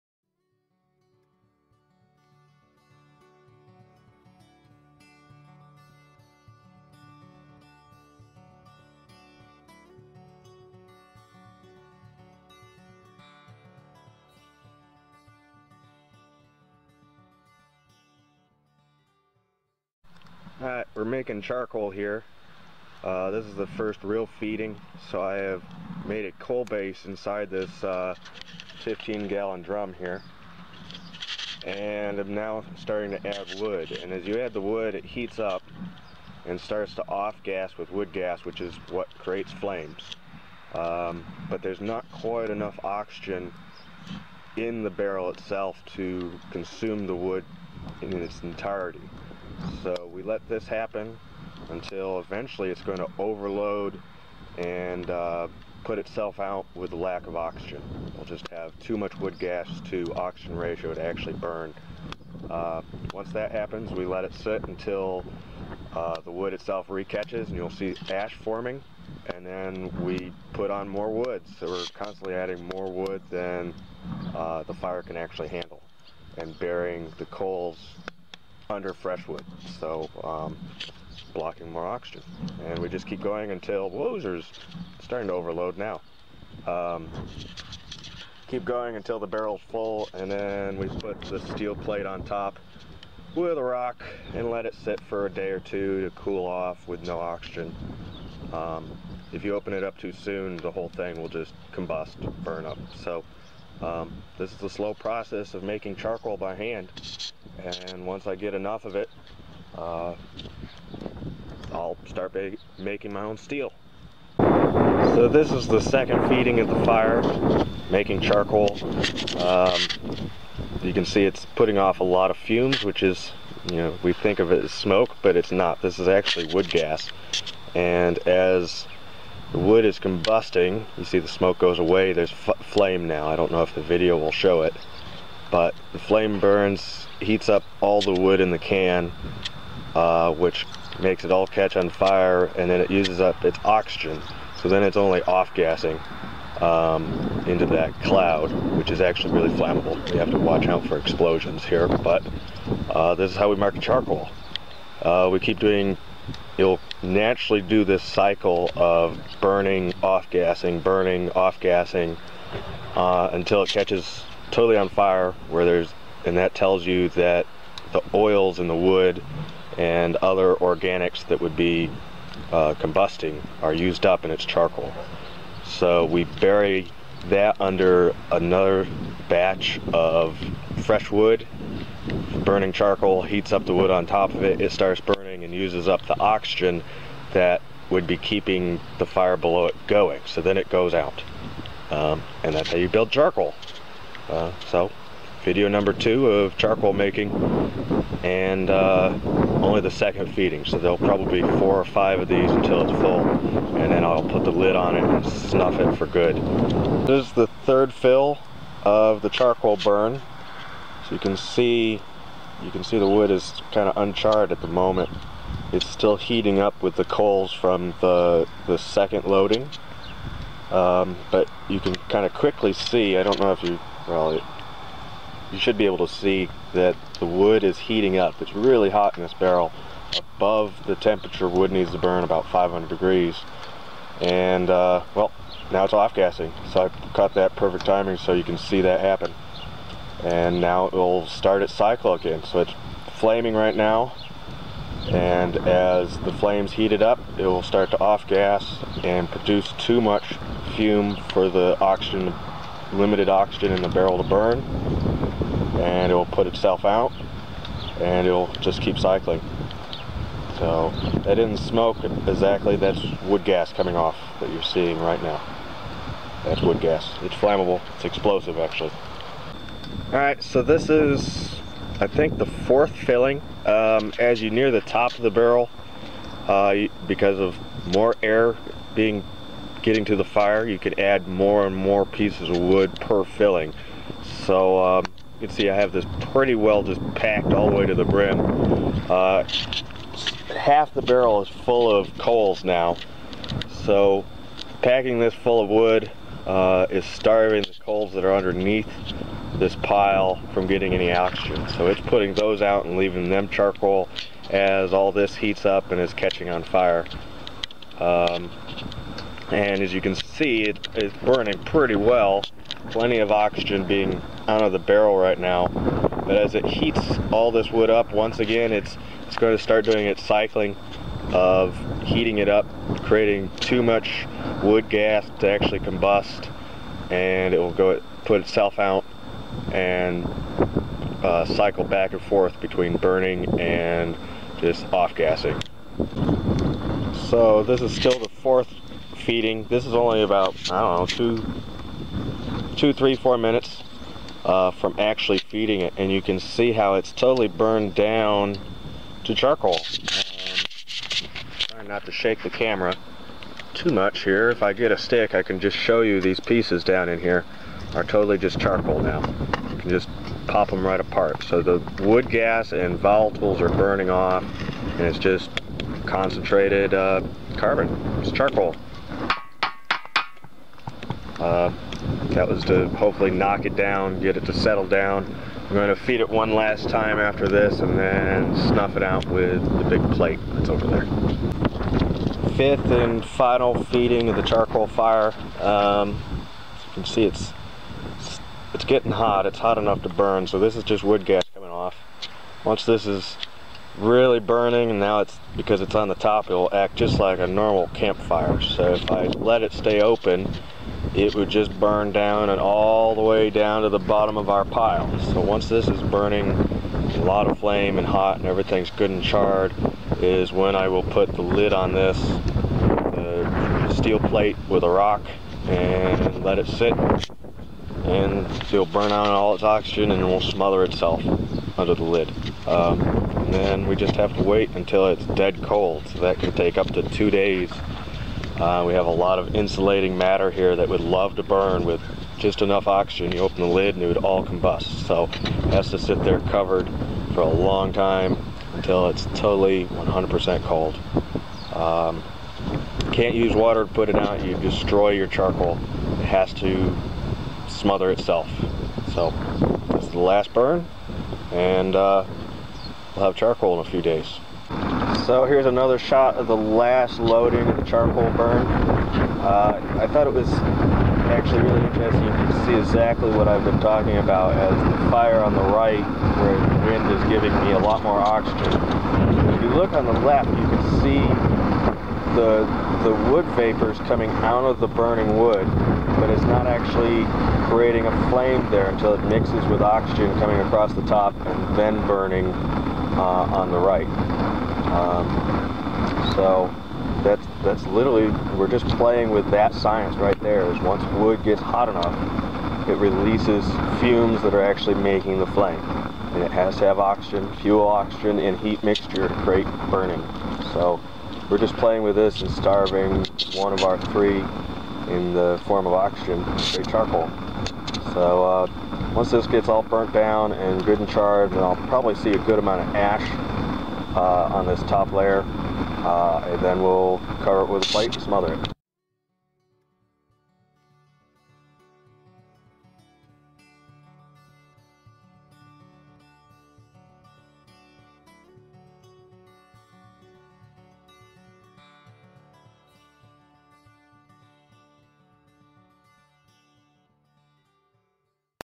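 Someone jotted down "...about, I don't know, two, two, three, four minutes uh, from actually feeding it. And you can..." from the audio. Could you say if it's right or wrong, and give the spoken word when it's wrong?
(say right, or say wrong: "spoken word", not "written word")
right.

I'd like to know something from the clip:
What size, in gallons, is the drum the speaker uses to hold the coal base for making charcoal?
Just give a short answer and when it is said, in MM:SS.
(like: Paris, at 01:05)
15 gallon, at 00:28.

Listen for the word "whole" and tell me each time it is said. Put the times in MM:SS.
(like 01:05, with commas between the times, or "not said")
01:40.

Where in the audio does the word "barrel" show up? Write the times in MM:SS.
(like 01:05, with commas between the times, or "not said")
00:44, 01:29, 03:49, 04:13, 04:35, 04:51, 05:14.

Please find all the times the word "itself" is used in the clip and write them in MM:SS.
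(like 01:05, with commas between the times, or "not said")
00:45, 00:55, 01:06, 04:16, 05:28, 07:00, 07:28.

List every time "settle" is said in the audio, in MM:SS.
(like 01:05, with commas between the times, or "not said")
06:14.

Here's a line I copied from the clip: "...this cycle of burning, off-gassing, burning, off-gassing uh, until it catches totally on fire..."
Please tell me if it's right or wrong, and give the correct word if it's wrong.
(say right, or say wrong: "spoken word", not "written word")
right.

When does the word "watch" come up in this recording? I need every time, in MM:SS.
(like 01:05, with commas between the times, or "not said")
02:30.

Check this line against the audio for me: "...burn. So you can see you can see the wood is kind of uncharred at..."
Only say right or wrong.
right.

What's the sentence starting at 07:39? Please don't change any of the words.
Uh, I thought it was actually really interesting.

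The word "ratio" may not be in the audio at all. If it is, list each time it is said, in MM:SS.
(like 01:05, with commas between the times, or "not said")
01:00.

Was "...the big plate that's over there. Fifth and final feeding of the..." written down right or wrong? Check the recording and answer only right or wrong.
right.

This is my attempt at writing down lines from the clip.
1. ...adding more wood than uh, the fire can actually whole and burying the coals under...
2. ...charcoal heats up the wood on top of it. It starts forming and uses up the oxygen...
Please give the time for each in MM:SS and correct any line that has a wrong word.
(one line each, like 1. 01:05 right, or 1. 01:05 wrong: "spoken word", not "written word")
1. 01:12 wrong: "handle", not "whole"
2. 03:02 wrong: "burning", not "forming".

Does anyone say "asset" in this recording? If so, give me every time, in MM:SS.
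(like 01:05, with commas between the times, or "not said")
not said.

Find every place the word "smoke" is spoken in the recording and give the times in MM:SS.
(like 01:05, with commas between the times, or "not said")
02:04, 02:11, 04:21.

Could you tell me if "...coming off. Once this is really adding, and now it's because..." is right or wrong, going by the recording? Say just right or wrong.
wrong.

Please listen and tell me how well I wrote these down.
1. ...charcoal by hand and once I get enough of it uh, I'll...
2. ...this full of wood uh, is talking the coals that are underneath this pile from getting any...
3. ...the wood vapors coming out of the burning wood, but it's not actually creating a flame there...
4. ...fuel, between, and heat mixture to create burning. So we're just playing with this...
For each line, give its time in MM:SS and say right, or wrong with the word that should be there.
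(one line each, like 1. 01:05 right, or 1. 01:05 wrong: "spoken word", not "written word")
1. 01:45 right
2. 04:55 wrong: "starving", not "talking"
3. 07:53 right
4. 08:17 wrong: "oxygen", not "between".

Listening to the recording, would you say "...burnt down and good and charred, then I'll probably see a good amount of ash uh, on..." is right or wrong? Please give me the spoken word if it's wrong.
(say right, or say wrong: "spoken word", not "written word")
right.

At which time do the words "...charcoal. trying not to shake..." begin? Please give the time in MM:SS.
05:49.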